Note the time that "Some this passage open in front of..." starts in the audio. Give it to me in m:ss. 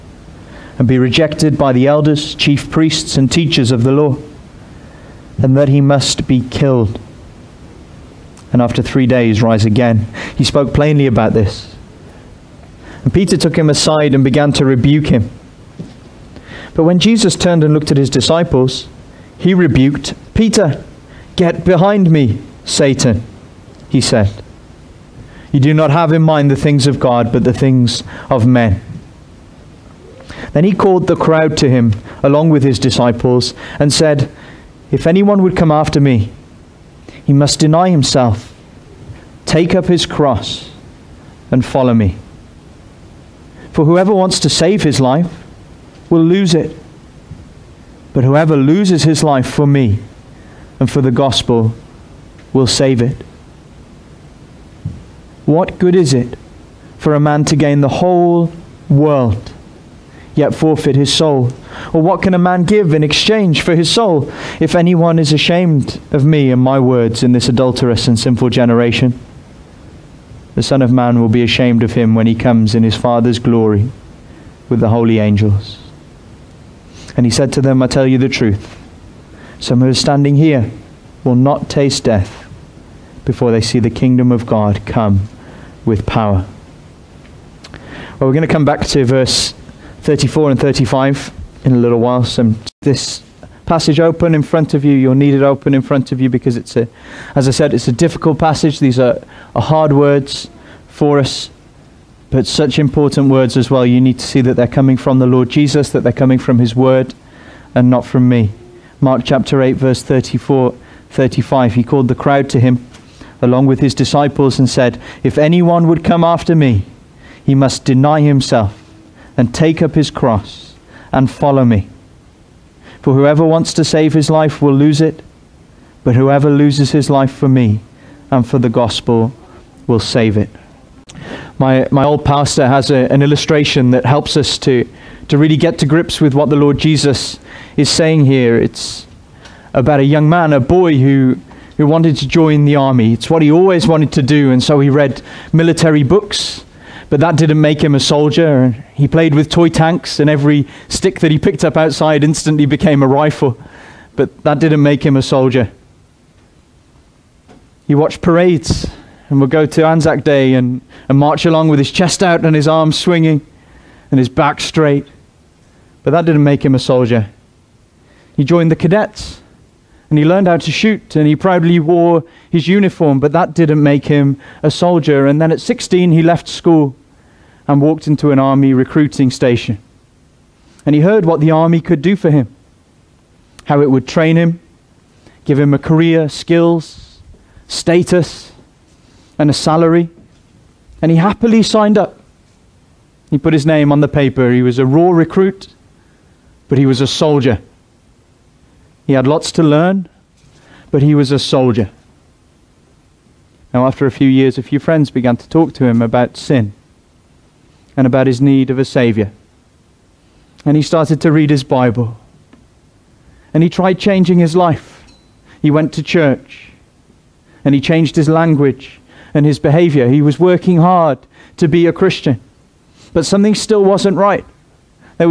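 1:32.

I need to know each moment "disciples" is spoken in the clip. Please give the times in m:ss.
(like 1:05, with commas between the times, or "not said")
0:18, 0:32, 1:53.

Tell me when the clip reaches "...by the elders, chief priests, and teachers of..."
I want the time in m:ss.
0:01.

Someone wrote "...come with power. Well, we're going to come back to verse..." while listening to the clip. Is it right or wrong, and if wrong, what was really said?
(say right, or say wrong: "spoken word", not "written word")
right.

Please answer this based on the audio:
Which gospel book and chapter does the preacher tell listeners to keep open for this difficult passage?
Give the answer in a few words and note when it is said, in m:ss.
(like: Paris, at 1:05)
Mark chapter 8, at 1:48.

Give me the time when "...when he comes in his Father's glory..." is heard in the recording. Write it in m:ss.
1:12.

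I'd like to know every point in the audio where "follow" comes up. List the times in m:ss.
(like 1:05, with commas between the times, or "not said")
0:41, 2:01.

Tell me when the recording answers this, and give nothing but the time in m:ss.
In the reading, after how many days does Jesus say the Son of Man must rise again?
0:08.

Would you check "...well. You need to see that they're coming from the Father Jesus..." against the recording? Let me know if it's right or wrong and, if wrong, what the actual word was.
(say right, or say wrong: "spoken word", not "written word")
wrong: "Lord", not "Father".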